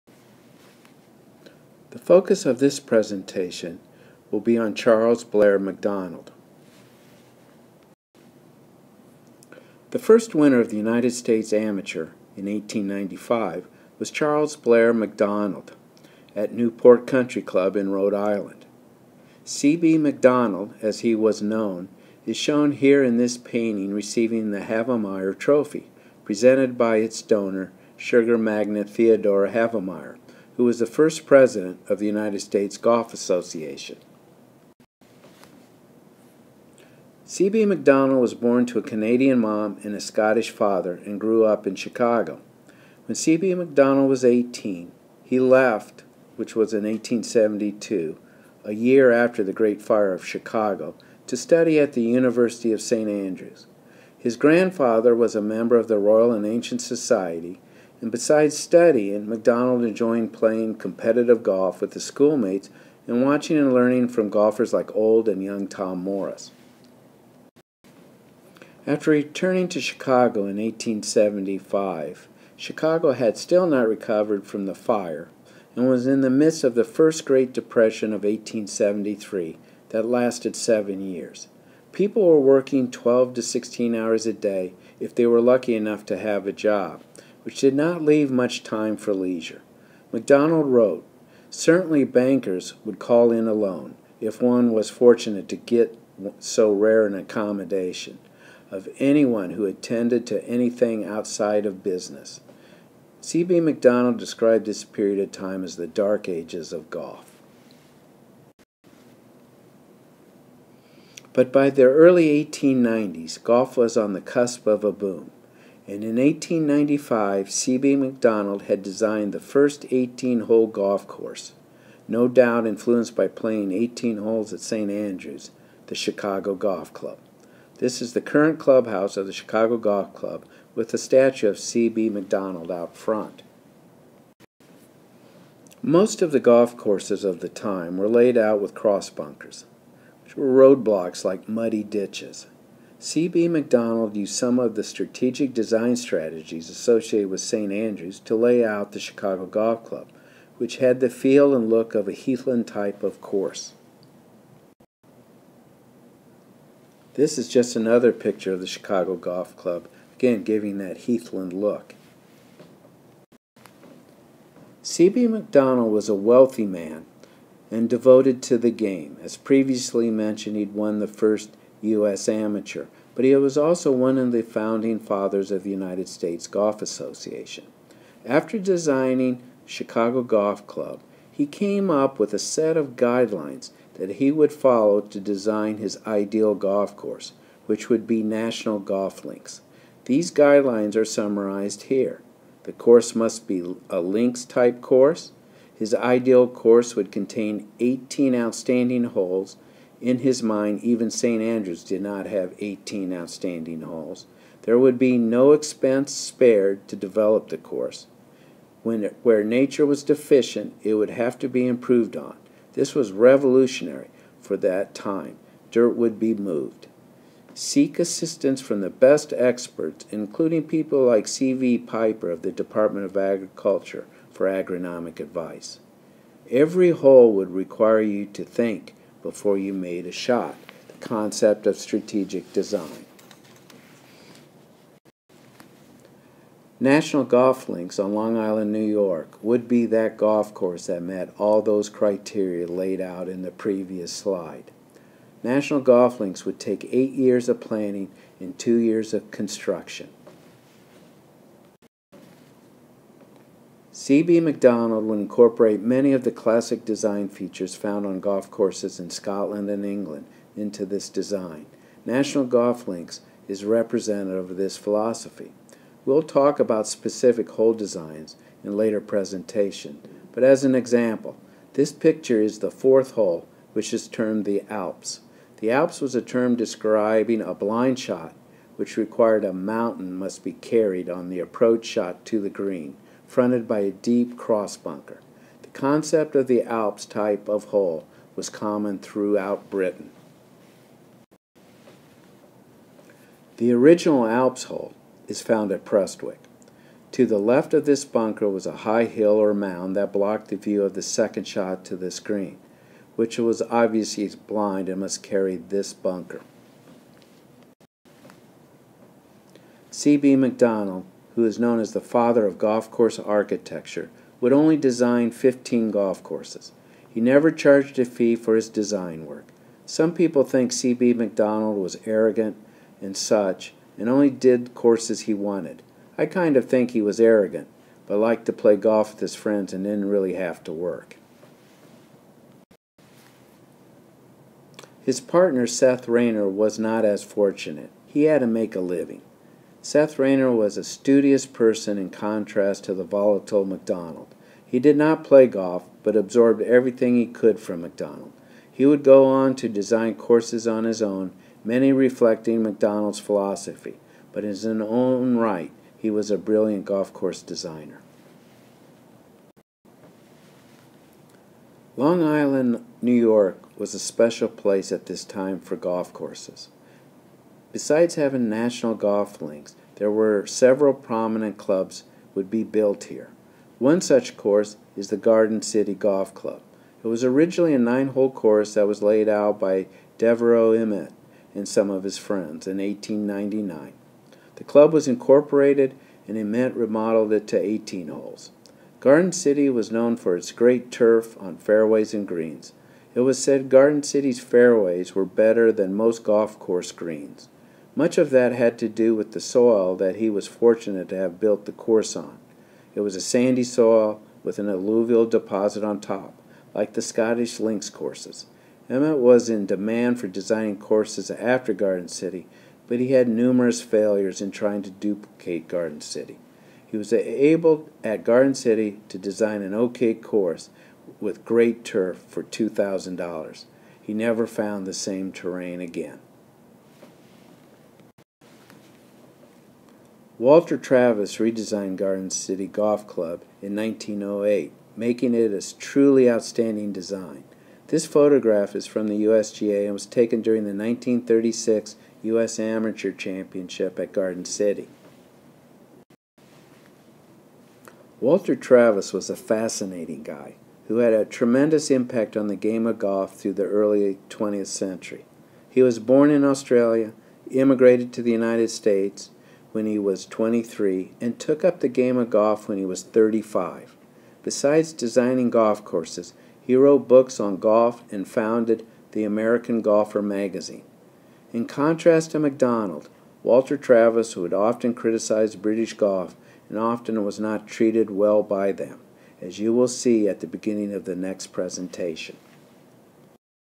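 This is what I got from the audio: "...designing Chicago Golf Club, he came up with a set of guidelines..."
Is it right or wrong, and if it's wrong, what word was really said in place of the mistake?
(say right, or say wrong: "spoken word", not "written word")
right.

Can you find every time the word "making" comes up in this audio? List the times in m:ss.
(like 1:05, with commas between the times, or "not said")
7:14.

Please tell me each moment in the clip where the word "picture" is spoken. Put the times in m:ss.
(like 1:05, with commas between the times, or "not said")
2:38, 4:31.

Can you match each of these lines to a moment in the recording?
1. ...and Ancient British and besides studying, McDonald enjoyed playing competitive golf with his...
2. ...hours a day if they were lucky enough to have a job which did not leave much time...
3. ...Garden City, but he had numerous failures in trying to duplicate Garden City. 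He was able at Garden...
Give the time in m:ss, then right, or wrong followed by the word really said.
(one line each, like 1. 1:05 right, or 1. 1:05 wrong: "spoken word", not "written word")
1. 0:56 wrong: "Society", not "British"
2. 1:23 right
3. 6:51 right.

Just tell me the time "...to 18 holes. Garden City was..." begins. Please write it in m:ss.
6:27.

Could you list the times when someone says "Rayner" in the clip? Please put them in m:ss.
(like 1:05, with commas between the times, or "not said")
5:36, 5:40.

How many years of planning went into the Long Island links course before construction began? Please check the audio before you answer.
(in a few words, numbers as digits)
8.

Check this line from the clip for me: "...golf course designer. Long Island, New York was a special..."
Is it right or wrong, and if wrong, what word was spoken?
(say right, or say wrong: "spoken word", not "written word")
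right.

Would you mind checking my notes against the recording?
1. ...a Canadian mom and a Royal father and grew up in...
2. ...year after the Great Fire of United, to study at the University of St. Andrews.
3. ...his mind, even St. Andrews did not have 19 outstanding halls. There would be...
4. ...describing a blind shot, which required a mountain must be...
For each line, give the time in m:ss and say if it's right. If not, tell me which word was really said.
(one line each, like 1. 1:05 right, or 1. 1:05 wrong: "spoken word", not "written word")
1. 0:38 wrong: "Scottish", not "Royal"
2. 0:48 wrong: "Chicago", not "United"
3. 3:20 wrong: "18", not "19"
4. 4:36 right.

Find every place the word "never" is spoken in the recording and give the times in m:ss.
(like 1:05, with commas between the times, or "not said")
5:17, 7:04.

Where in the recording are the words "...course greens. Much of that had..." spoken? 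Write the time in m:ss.
6:36.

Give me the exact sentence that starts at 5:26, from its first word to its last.
I kind of think he was arrogant, but liked to play golf with his friends and didn't really have to work.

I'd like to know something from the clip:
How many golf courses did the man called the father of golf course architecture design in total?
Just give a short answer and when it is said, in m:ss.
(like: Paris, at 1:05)
15, at 5:15.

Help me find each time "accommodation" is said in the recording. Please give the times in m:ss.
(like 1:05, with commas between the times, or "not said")
1:37.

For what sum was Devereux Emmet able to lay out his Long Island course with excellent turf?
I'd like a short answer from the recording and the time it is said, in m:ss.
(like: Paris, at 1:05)
$2,000, at 7:02.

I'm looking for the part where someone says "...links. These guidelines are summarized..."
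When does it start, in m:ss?
3:09.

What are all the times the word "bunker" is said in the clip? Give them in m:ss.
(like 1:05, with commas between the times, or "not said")
2:19, 4:44, 4:58, 5:05.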